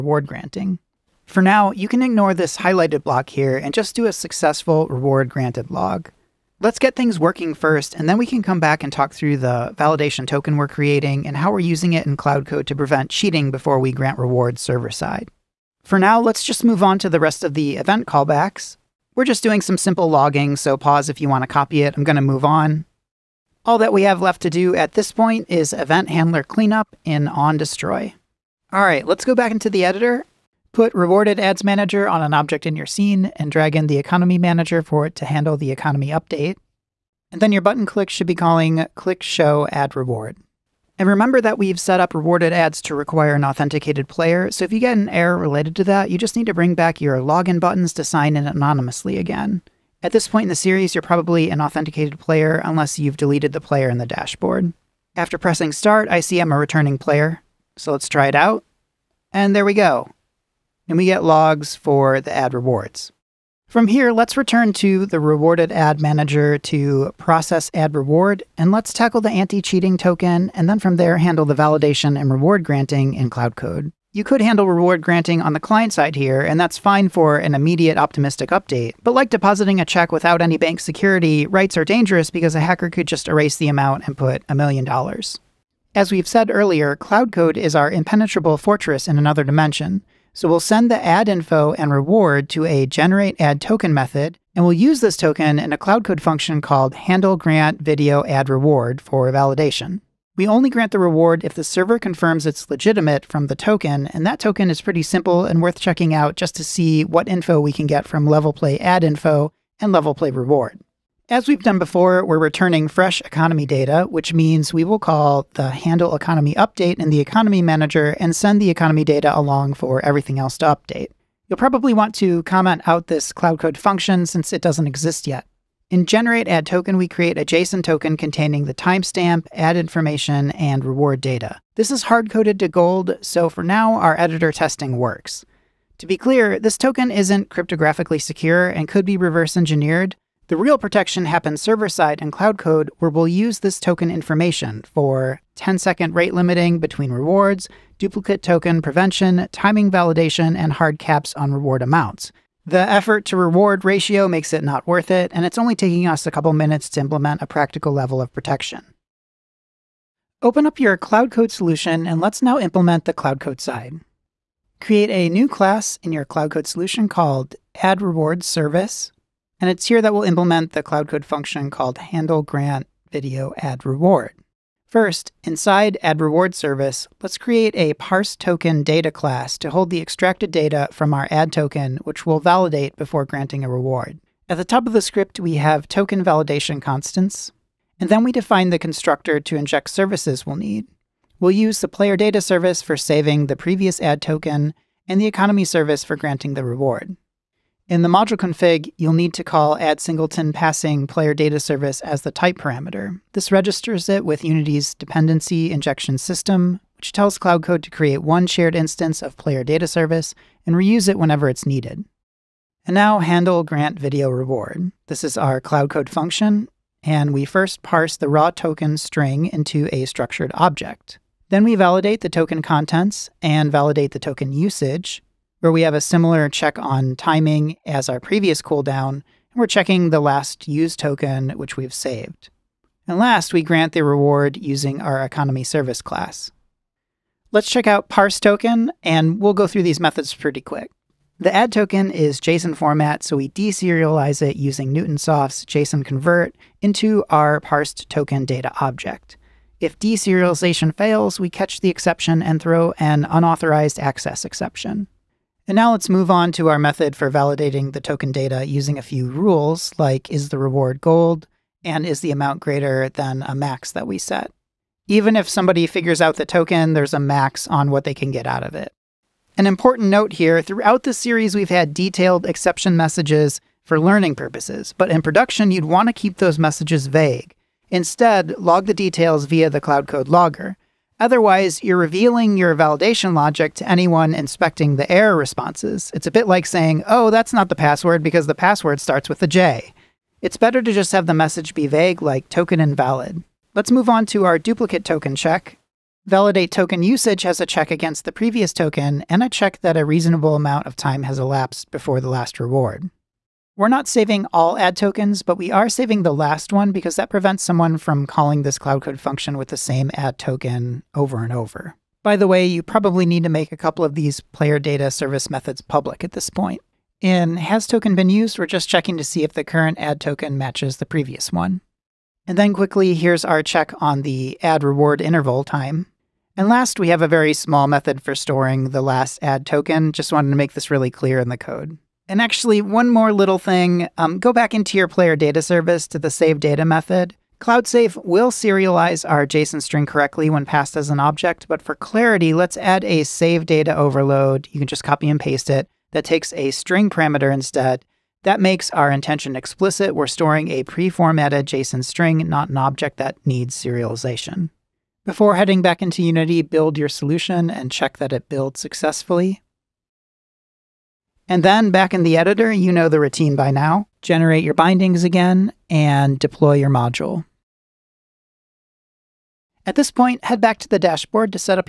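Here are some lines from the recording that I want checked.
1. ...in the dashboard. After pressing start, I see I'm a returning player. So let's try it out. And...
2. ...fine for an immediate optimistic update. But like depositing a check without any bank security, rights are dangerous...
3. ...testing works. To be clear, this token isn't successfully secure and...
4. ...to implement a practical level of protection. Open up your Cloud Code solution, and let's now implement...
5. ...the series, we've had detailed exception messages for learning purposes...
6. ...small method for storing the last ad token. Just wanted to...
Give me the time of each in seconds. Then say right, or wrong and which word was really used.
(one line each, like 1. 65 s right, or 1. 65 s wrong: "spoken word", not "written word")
1. 53 s right
2. 76 s right
3. 134 s wrong: "cryptographically", not "successfully"
4. 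156 s right
5. 271 s right
6. 327 s right.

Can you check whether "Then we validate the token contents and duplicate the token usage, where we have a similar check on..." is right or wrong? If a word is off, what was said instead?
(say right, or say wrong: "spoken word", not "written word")
wrong: "validate", not "duplicate".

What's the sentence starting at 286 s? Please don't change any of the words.
It's a bit like saying, oh, that's not the password because the password starts with a J.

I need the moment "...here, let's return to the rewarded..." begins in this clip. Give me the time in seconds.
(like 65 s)
63 s.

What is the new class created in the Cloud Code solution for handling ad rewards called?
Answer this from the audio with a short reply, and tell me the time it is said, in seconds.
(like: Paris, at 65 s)
Ad Rewards Service, at 167 s.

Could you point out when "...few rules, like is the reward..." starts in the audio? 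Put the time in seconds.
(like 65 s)
259 s.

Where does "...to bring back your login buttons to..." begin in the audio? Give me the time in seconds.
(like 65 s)
46 s.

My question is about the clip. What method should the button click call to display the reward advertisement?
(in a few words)
click show ad reward.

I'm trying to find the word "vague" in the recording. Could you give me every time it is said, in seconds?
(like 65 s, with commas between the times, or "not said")
277 s, 291 s.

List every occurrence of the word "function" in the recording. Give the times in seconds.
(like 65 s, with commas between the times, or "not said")
96 s, 123 s, 171 s, 216 s, 309 s.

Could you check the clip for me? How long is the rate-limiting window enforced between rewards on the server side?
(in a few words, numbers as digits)
10 seconds.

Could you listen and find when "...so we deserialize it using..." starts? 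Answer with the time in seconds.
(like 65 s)
243 s.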